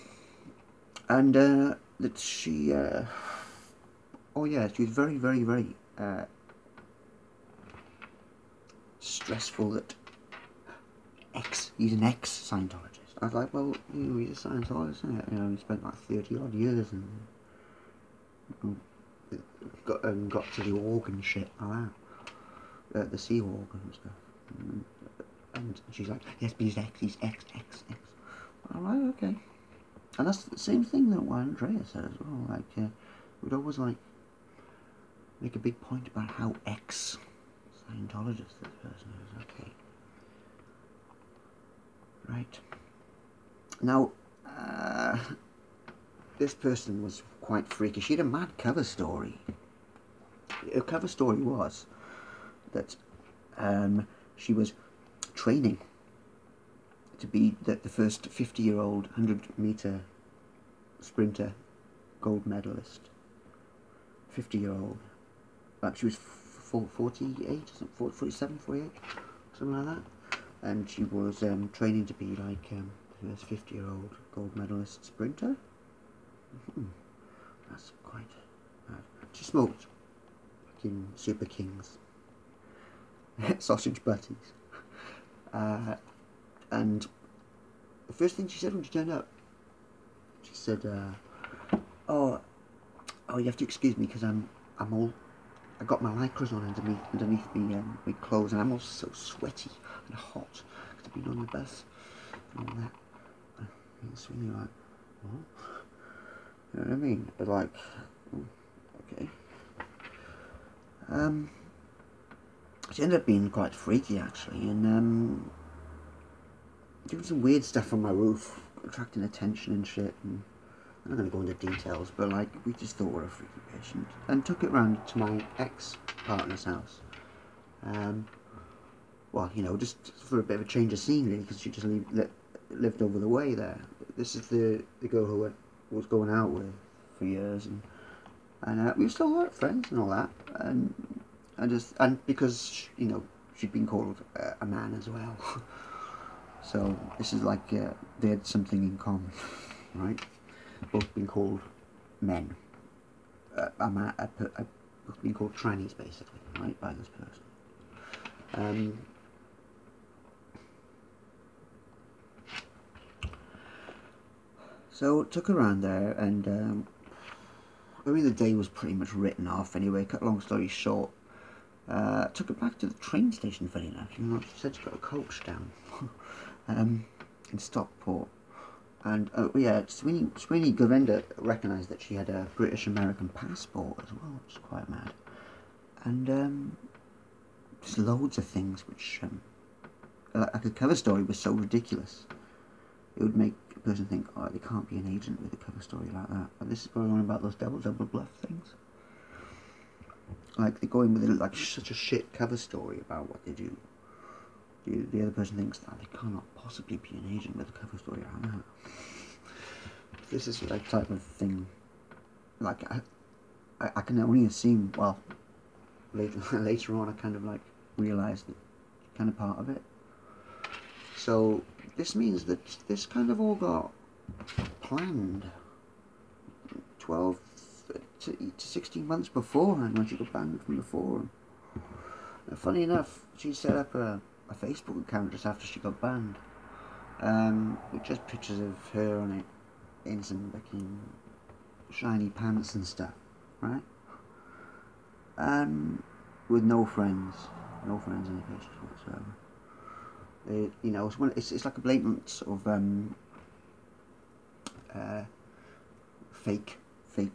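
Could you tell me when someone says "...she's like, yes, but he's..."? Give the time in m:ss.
0:25.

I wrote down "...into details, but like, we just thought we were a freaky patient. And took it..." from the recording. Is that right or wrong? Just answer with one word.
right.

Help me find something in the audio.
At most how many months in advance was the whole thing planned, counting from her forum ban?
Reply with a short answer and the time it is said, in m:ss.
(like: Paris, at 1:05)
16, at 3:48.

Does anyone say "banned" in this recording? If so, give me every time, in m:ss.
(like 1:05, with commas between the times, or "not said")
3:50, 3:56.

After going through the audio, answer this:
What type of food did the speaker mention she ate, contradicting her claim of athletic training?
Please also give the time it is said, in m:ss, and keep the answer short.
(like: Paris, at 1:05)
sausage butties, at 1:23.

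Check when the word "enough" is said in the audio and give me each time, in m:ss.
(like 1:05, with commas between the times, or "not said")
2:53, 3:52.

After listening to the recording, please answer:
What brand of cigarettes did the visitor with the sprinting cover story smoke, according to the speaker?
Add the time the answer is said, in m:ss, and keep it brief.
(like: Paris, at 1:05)
Super Kings, at 1:21.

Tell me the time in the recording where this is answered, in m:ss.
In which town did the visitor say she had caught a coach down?
2:57.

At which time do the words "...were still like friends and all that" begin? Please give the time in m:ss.
2:19.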